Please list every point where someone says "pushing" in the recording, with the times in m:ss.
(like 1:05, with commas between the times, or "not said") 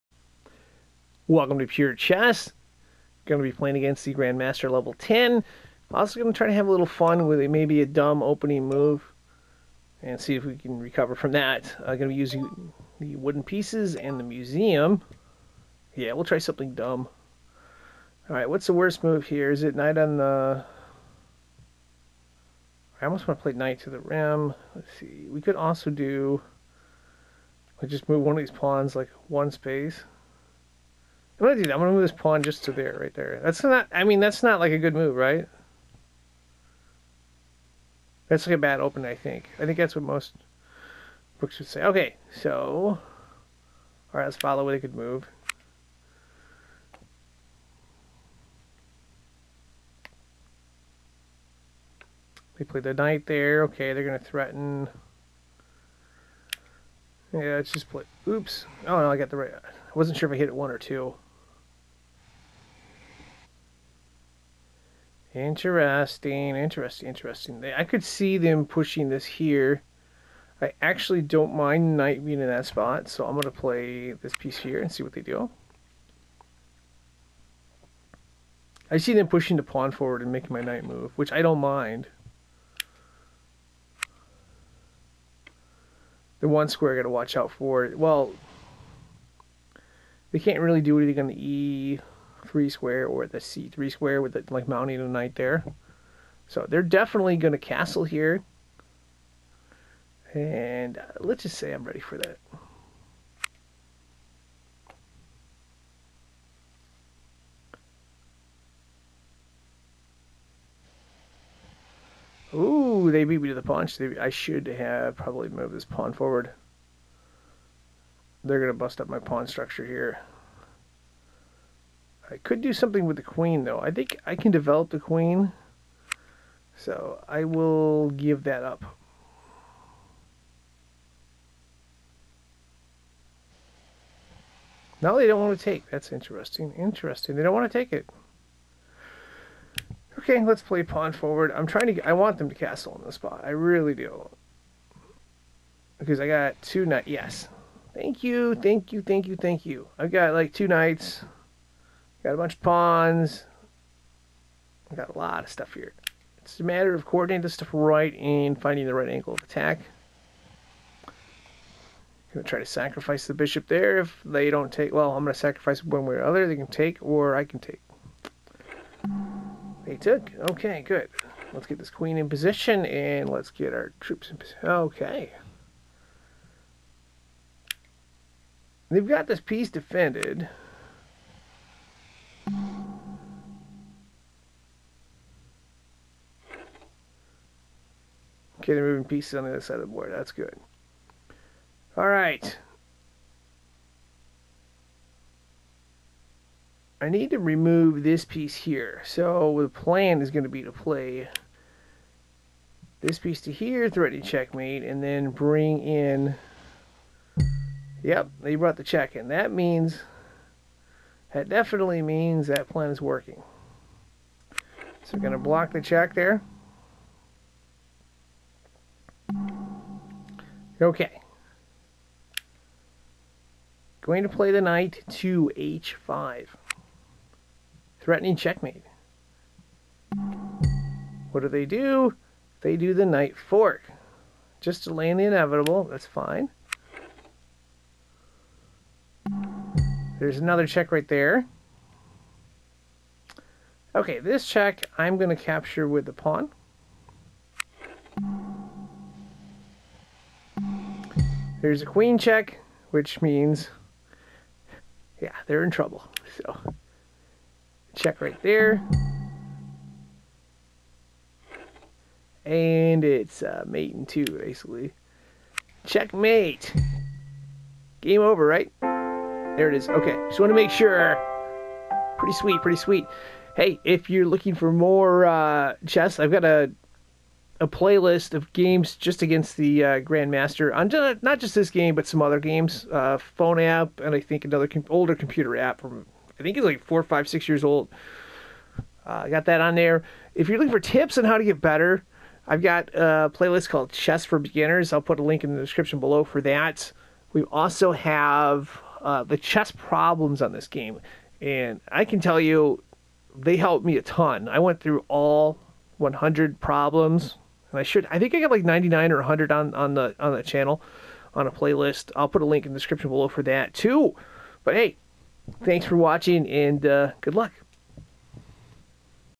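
1:08, 1:19.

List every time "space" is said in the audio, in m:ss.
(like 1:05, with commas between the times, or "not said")
0:29.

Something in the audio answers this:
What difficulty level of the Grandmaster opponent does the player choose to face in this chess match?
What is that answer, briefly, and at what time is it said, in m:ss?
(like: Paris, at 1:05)
10, at 0:04.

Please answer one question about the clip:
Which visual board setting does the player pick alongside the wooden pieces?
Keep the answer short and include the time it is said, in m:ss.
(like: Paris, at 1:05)
The museum, at 0:14.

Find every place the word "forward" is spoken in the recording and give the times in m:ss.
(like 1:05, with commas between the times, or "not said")
1:19, 1:56, 2:21.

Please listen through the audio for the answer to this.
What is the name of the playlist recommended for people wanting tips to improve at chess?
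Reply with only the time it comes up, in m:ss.
4:53.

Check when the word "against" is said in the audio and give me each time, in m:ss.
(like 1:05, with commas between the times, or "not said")
0:03, 4:39.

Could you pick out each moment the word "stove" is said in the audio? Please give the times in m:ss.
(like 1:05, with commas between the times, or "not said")
not said.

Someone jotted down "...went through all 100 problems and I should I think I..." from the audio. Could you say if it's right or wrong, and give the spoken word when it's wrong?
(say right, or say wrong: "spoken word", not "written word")
right.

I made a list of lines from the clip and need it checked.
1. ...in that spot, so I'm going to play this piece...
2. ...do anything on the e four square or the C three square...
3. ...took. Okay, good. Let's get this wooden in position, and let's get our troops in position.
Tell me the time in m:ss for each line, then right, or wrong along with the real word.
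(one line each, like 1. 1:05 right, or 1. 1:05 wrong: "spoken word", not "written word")
1. 1:12 right
2. 1:30 wrong: "three", not "four"
3. 2:49 wrong: "queen", not "wooden".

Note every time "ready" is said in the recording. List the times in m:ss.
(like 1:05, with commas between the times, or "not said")
1:41.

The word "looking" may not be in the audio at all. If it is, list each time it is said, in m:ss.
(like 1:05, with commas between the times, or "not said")
4:34, 4:50.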